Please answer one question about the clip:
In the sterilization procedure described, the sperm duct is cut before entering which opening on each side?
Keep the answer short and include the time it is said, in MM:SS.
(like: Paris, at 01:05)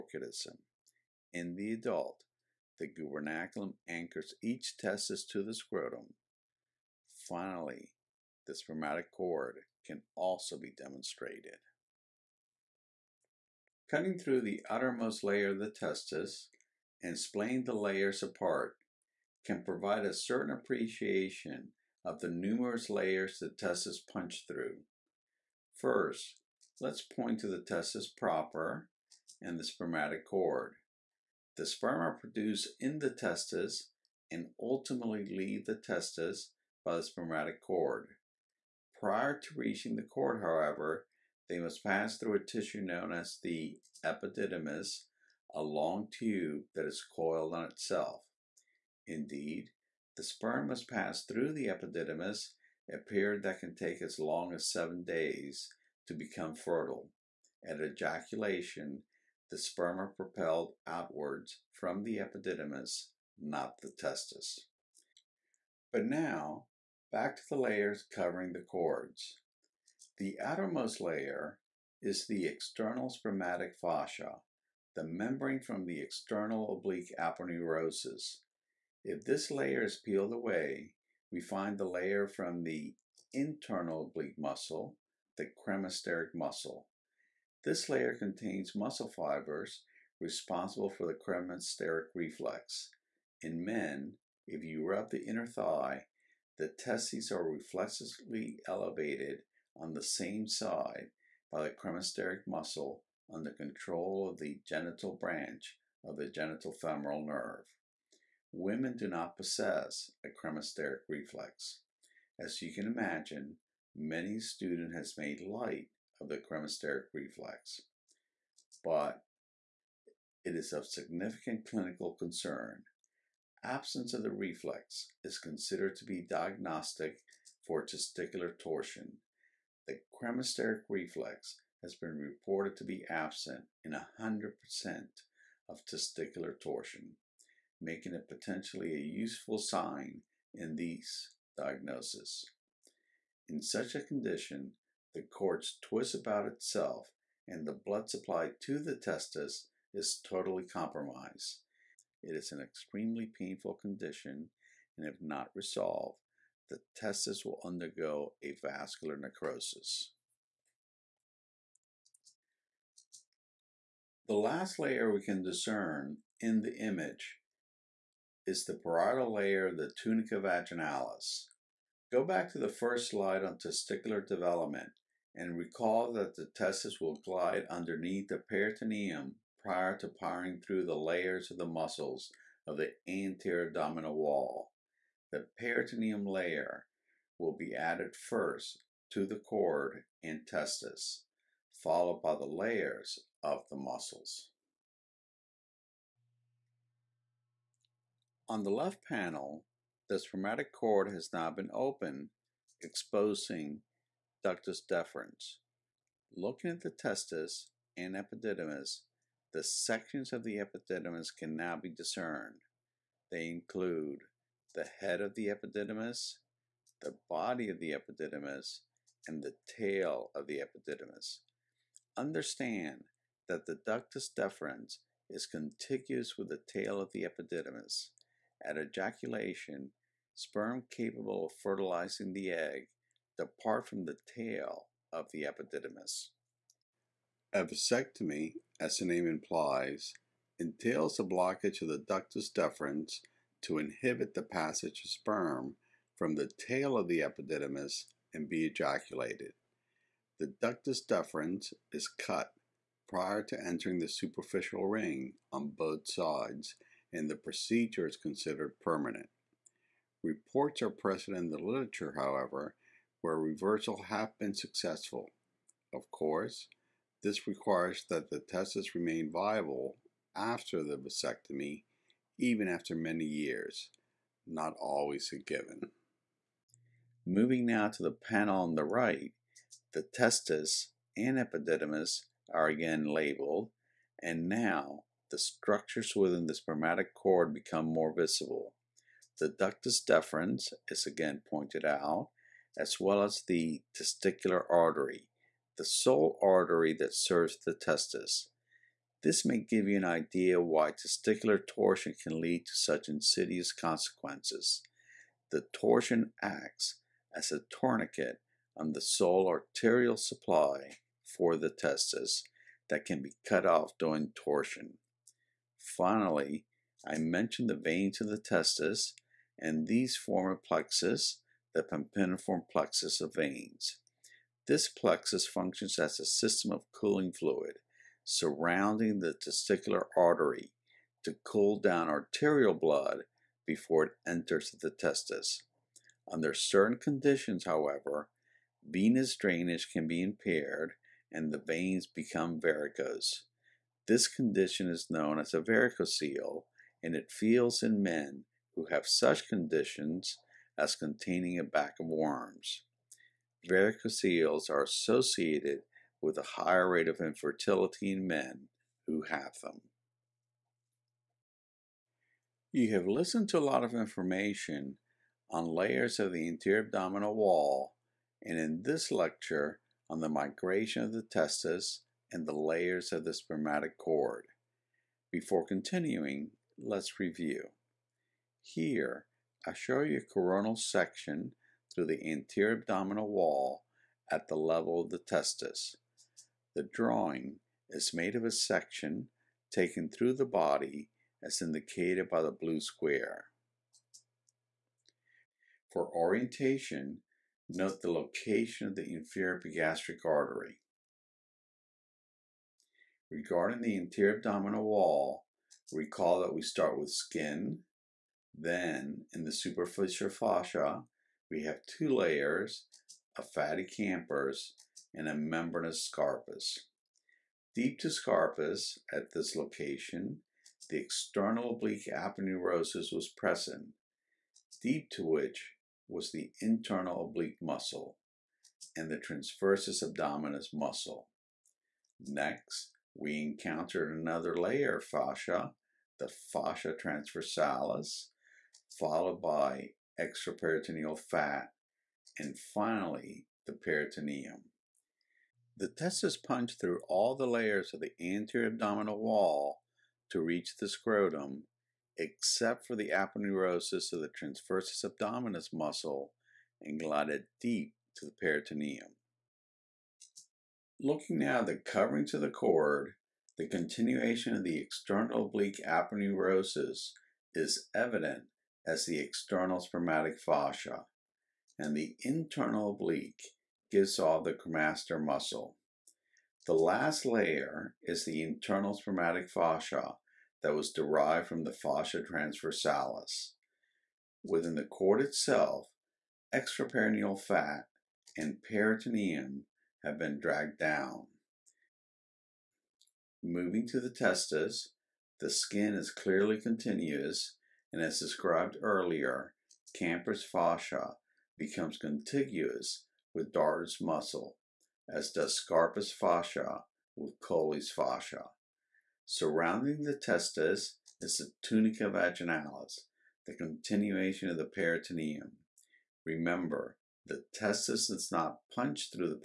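superficial ring, at 04:14.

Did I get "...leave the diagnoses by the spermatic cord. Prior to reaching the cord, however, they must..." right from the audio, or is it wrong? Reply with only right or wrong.
wrong.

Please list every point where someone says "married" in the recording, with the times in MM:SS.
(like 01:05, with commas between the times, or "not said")
not said.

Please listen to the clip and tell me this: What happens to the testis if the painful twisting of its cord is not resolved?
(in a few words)
avascular necrosis.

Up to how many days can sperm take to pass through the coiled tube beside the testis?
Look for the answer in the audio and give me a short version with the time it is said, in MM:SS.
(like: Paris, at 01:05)
7, at 00:54.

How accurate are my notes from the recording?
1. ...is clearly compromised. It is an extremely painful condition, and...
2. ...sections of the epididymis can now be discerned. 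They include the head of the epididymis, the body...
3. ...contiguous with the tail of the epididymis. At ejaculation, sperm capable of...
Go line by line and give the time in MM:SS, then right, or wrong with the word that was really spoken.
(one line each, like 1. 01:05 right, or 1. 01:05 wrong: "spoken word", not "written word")
1. 02:29 wrong: "totally", not "clearly"
2. 03:29 right
3. 03:45 right.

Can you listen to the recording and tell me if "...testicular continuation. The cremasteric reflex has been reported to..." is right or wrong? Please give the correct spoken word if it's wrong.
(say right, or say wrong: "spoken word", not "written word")
wrong: "torsion", not "continuation".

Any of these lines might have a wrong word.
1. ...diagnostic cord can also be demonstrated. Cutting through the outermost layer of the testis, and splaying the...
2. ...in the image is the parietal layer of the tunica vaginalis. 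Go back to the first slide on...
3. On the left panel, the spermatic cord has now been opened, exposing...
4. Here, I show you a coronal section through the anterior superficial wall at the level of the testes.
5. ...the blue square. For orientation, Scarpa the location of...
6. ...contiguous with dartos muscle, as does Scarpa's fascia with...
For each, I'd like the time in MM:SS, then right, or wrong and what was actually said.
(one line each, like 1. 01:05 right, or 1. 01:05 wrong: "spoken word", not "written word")
1. 00:08 wrong: "spermatic", not "diagnostic"
2. 02:46 right
3. 03:18 right
4. 06:18 wrong: "abdominal", not "superficial"
5. 06:32 wrong: "Note", not "Scarpa"
6. 08:21 right.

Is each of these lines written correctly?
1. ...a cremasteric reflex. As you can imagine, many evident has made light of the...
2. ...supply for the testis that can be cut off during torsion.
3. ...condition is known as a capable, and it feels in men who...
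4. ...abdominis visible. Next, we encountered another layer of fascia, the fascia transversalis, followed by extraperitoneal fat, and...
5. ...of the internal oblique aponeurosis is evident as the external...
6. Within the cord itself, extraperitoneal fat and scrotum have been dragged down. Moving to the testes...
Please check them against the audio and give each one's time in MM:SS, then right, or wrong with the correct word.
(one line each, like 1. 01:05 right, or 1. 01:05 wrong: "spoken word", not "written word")
1. 01:50 wrong: "student", not "evident"
2. 05:10 right
3. 05:44 wrong: "varicocele", not "capable"
4. 07:10 wrong: "muscle", not "visible"
5. 07:44 wrong: "external", not "internal"
6. 08:04 wrong: "peritoneum", not "scrotum".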